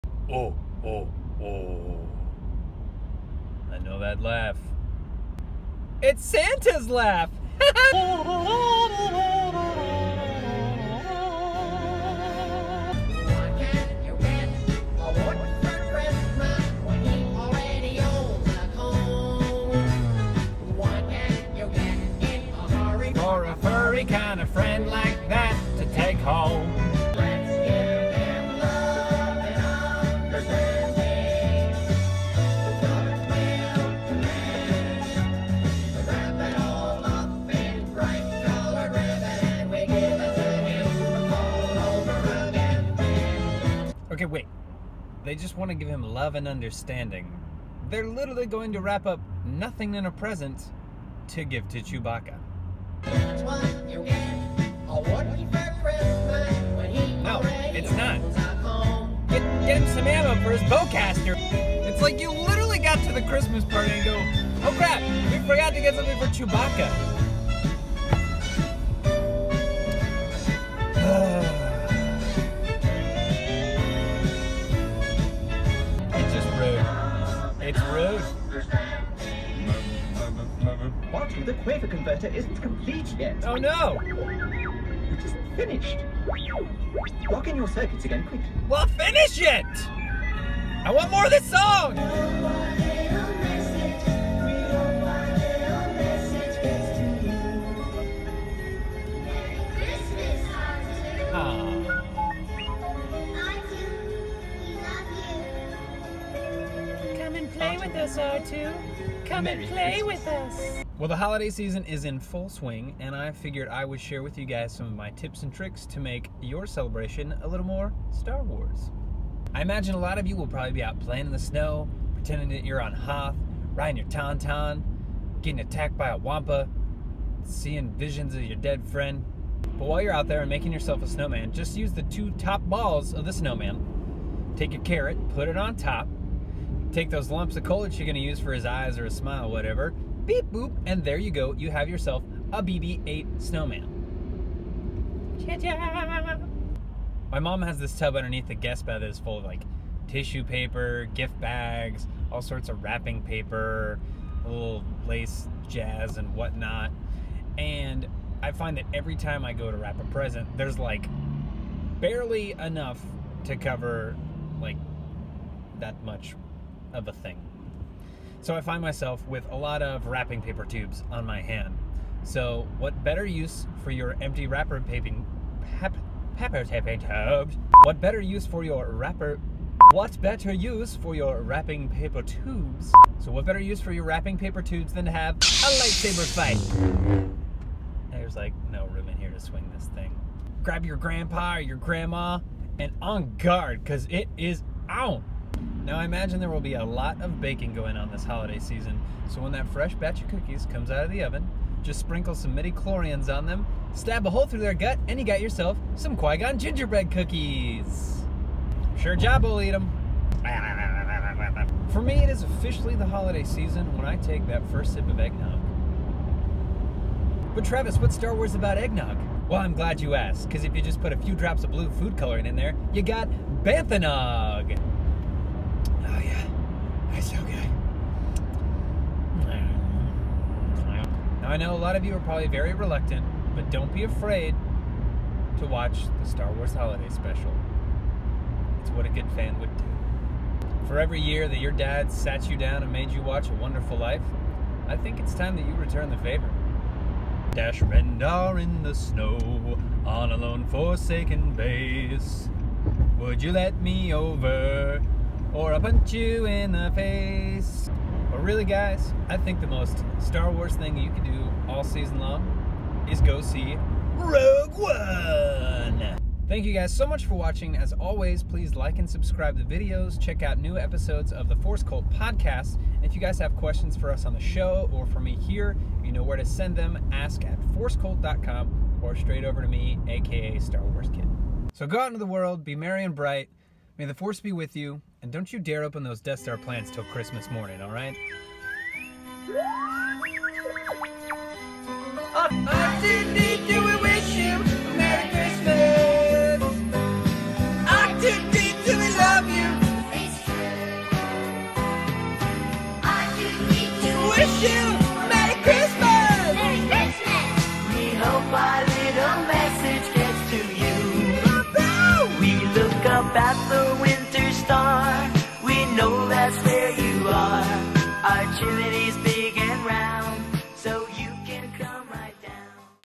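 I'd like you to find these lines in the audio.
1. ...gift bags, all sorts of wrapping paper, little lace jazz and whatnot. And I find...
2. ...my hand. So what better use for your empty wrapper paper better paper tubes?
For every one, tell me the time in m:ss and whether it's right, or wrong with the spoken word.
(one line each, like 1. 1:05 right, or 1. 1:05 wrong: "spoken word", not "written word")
1. 2:31 right
2. 2:51 wrong: "paper", not "better".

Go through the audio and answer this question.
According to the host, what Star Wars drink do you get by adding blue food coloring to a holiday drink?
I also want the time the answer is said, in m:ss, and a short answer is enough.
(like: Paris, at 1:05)
Banthanog, at 3:43.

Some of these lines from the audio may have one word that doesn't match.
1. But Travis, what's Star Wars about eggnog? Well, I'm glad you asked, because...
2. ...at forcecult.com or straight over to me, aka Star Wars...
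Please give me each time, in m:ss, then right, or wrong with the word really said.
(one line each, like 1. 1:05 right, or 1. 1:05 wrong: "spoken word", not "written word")
1. 3:37 right
2. 4:37 right.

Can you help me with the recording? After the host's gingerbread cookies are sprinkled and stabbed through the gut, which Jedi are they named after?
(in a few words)
Qui-Gon.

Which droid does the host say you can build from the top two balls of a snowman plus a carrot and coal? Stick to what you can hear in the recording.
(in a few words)
BB-8.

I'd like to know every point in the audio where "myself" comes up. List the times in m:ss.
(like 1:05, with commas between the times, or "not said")
2:48.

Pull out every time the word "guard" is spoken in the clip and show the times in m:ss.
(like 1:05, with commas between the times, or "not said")
3:13.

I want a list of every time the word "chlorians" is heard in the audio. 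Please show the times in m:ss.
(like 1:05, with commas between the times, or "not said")
3:22.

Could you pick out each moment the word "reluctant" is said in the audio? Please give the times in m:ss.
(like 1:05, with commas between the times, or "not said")
3:52.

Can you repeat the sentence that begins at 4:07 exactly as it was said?
Dash Rendar in the snow on a lone forsaken base.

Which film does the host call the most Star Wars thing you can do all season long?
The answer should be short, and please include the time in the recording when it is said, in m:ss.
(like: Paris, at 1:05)
Rogue One, at 4:24.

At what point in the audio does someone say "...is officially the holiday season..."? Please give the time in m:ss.
3:32.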